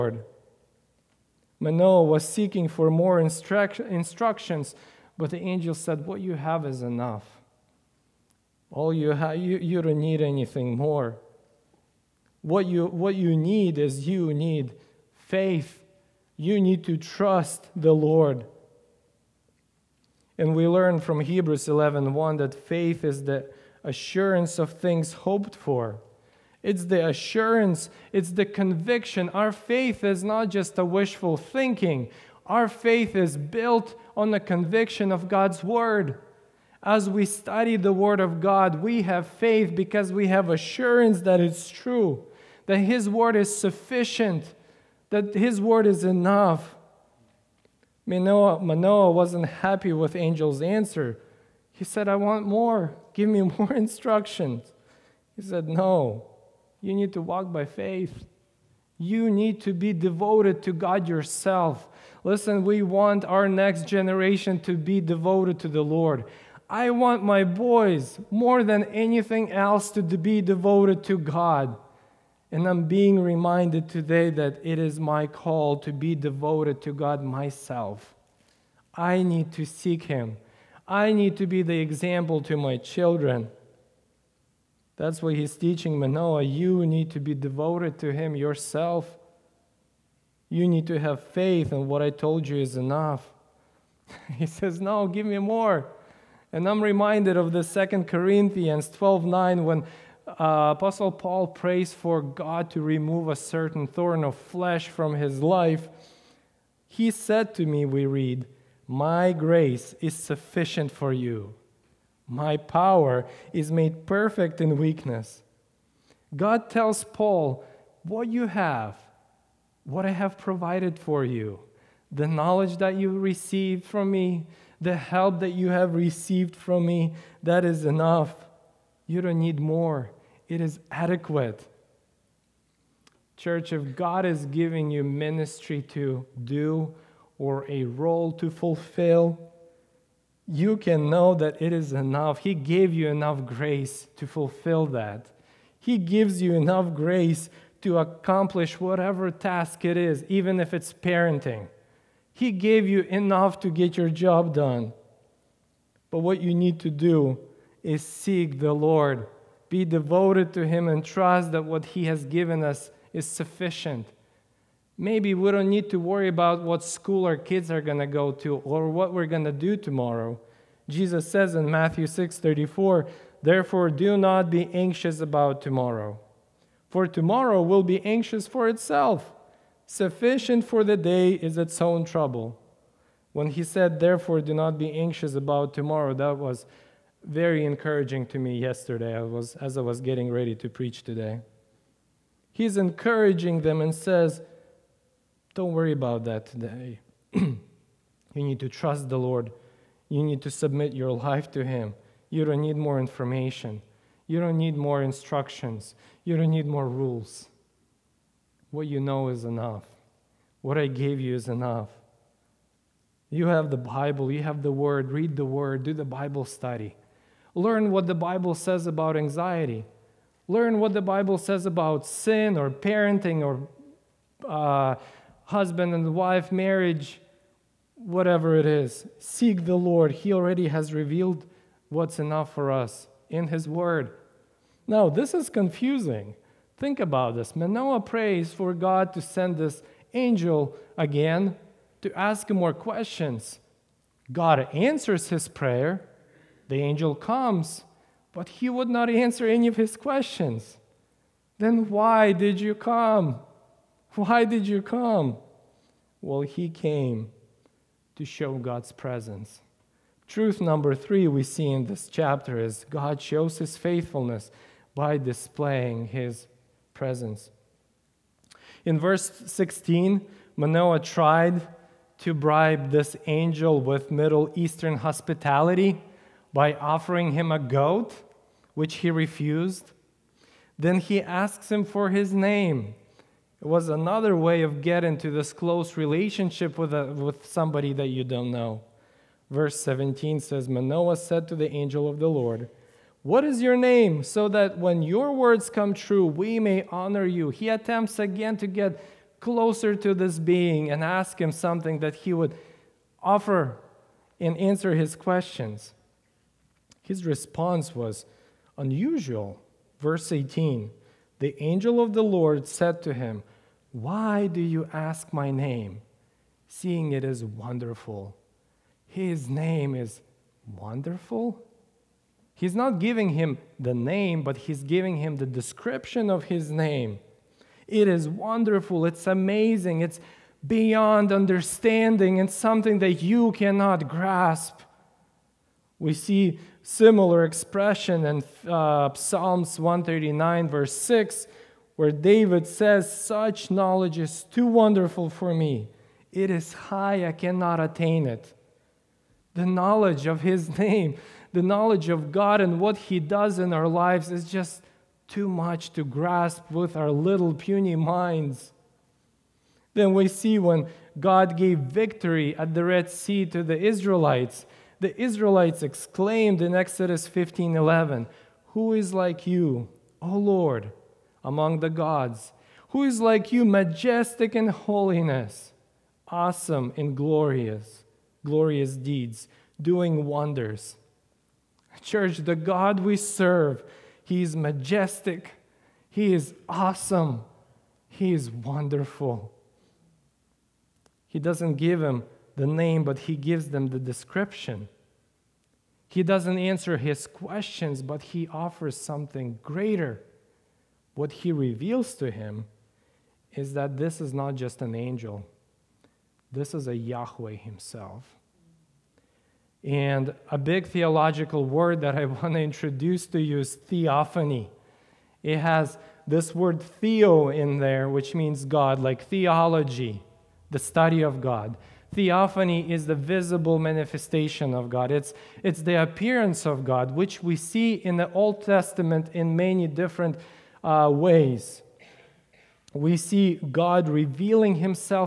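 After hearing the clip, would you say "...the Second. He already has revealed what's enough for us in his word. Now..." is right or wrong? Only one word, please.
wrong.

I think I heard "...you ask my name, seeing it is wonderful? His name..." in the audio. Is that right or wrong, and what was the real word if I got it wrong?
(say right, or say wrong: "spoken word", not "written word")
right.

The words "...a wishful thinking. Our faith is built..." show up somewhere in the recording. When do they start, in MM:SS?
00:30.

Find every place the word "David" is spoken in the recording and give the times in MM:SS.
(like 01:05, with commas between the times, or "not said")
05:42.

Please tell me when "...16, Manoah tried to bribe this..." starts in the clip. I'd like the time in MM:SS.
04:29.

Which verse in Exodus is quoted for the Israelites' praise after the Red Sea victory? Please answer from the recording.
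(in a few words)
Exodus 15:11.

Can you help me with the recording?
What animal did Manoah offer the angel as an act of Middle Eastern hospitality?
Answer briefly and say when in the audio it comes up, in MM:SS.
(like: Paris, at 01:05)
A goat, at 04:37.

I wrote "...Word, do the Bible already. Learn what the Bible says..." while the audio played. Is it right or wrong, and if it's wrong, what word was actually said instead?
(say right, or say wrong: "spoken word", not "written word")
wrong: "study", not "already".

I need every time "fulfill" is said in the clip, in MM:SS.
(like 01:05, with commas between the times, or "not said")
02:18, 02:24.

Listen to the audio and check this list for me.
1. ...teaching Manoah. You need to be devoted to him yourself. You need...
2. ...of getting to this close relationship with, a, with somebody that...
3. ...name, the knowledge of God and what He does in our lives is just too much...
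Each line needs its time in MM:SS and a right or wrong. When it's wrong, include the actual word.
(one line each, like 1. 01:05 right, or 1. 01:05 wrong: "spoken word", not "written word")
1. 01:25 right
2. 04:44 right
3. 05:50 right.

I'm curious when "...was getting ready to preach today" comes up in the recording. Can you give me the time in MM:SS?
03:09.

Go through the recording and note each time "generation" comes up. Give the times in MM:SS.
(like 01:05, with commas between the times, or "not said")
01:03.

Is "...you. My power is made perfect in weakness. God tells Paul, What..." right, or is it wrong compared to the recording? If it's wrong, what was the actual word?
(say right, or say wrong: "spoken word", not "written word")
right.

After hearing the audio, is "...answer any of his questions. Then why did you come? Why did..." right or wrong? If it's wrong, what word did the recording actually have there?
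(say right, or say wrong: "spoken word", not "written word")
right.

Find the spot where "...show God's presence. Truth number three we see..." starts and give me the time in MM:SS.
04:18.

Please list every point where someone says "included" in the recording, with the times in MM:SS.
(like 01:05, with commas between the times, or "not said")
not said.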